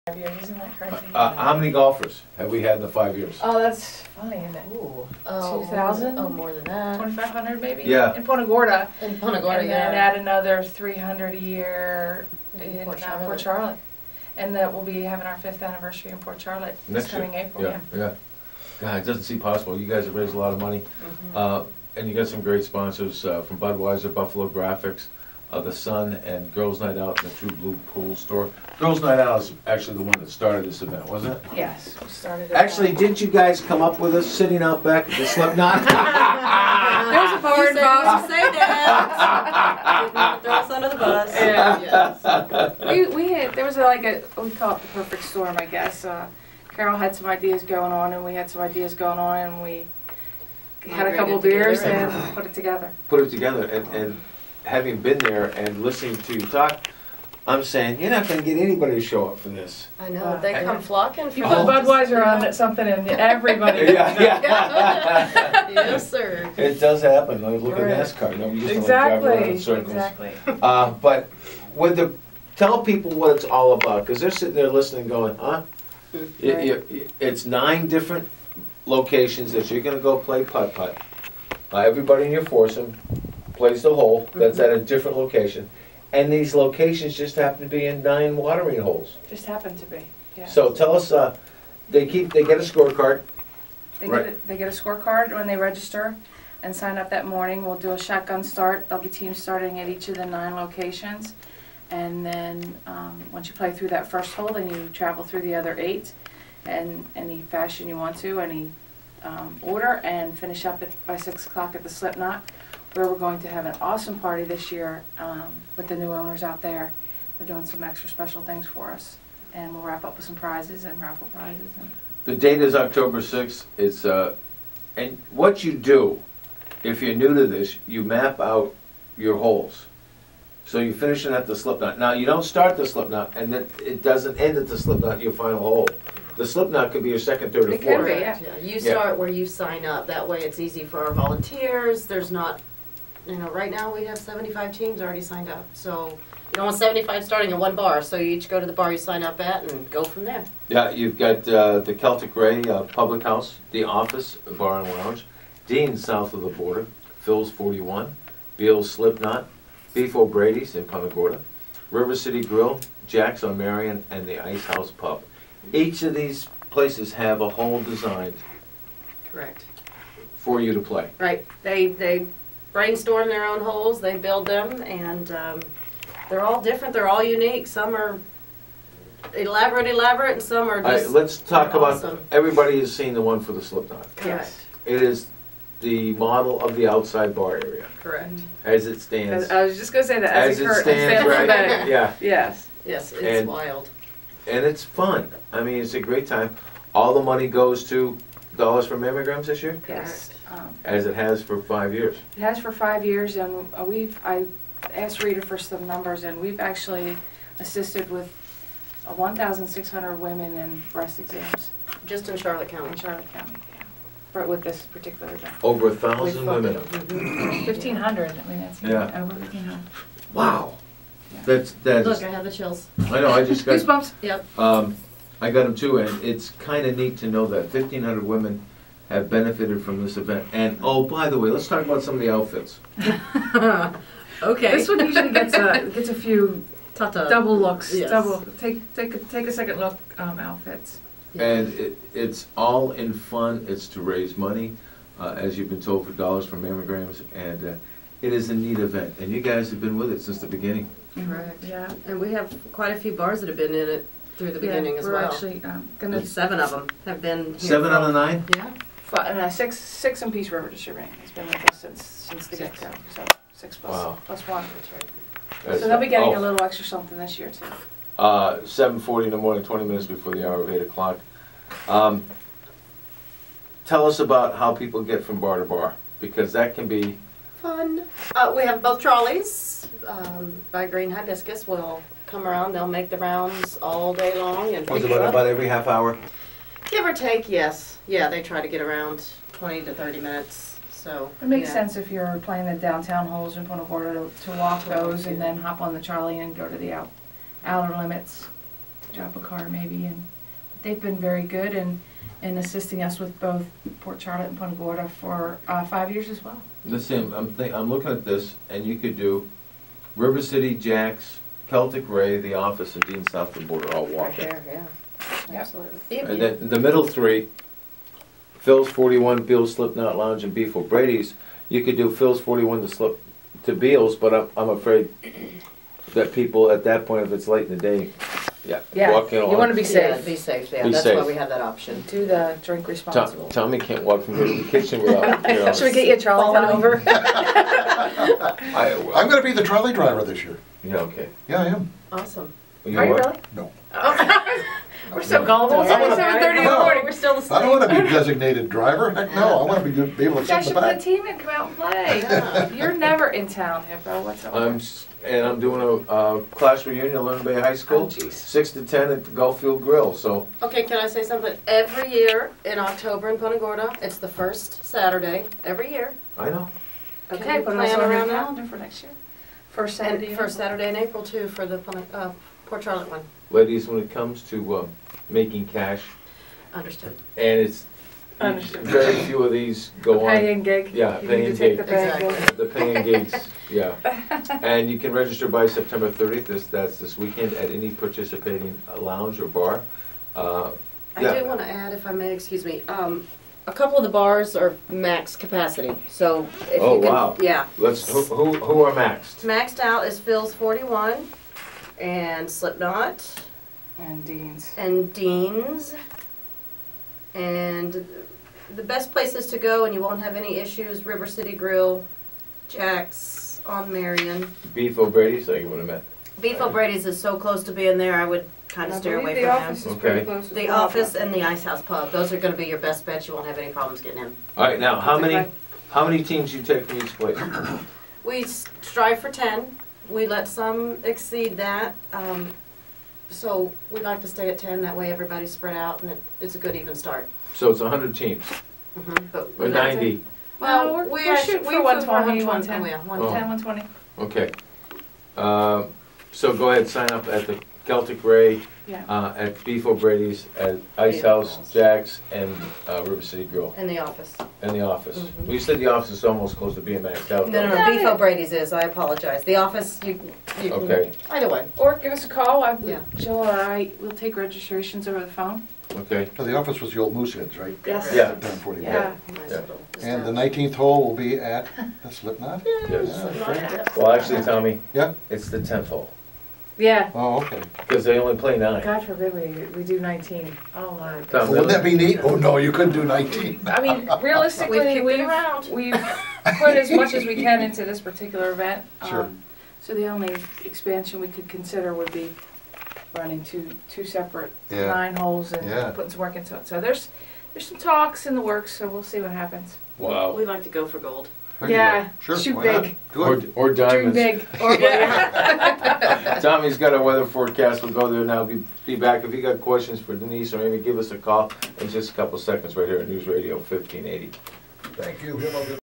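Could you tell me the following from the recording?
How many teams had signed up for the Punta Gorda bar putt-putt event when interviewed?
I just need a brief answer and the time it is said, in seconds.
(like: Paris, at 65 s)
75, at 144 s.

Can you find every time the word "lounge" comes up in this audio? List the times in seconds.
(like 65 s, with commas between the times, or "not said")
154 s, 320 s, 389 s.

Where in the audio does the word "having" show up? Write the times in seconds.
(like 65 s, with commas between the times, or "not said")
15 s, 54 s.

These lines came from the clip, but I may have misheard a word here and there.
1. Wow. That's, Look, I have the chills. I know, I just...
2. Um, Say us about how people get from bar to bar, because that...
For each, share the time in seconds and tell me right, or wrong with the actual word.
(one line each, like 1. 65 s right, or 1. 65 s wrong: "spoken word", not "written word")
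1. 220 s right
2. 271 s wrong: "Tell", not "Say".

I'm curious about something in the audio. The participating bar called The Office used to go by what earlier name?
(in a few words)
Mooseheads.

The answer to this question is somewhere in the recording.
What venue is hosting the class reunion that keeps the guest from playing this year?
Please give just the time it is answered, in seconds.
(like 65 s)
359 s.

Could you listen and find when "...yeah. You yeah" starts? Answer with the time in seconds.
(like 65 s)
138 s.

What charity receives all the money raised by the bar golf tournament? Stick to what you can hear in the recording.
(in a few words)
Dollars for Mammograms.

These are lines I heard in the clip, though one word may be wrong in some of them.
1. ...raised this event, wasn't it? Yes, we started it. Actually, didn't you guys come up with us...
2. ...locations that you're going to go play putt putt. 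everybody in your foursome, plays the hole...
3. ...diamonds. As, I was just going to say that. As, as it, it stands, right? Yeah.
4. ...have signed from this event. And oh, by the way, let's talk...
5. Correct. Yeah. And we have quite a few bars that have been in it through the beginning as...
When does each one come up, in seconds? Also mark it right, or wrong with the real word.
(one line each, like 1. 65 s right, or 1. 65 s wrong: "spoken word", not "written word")
1. 30 s wrong: "started", not "raised"
2. 78 s right
3. 189 s wrong: "stands", not "diamonds"
4. 229 s wrong: "benefited", not "signed"
5. 251 s right.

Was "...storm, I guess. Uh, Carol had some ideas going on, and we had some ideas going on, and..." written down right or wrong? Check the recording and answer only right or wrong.
right.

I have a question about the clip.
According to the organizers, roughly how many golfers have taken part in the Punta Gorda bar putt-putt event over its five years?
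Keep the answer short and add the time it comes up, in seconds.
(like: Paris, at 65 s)
2,500, at 6 s.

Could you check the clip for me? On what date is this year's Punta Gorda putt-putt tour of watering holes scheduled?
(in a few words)
October 6th.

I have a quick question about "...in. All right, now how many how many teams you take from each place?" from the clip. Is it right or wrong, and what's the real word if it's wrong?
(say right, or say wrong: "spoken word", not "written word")
right.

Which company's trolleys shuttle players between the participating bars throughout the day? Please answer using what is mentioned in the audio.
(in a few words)
Green Hibiscus.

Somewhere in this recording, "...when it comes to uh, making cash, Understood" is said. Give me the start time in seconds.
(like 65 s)
373 s.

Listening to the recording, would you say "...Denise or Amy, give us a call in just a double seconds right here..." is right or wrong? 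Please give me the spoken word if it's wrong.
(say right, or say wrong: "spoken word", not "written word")
wrong: "couple", not "double".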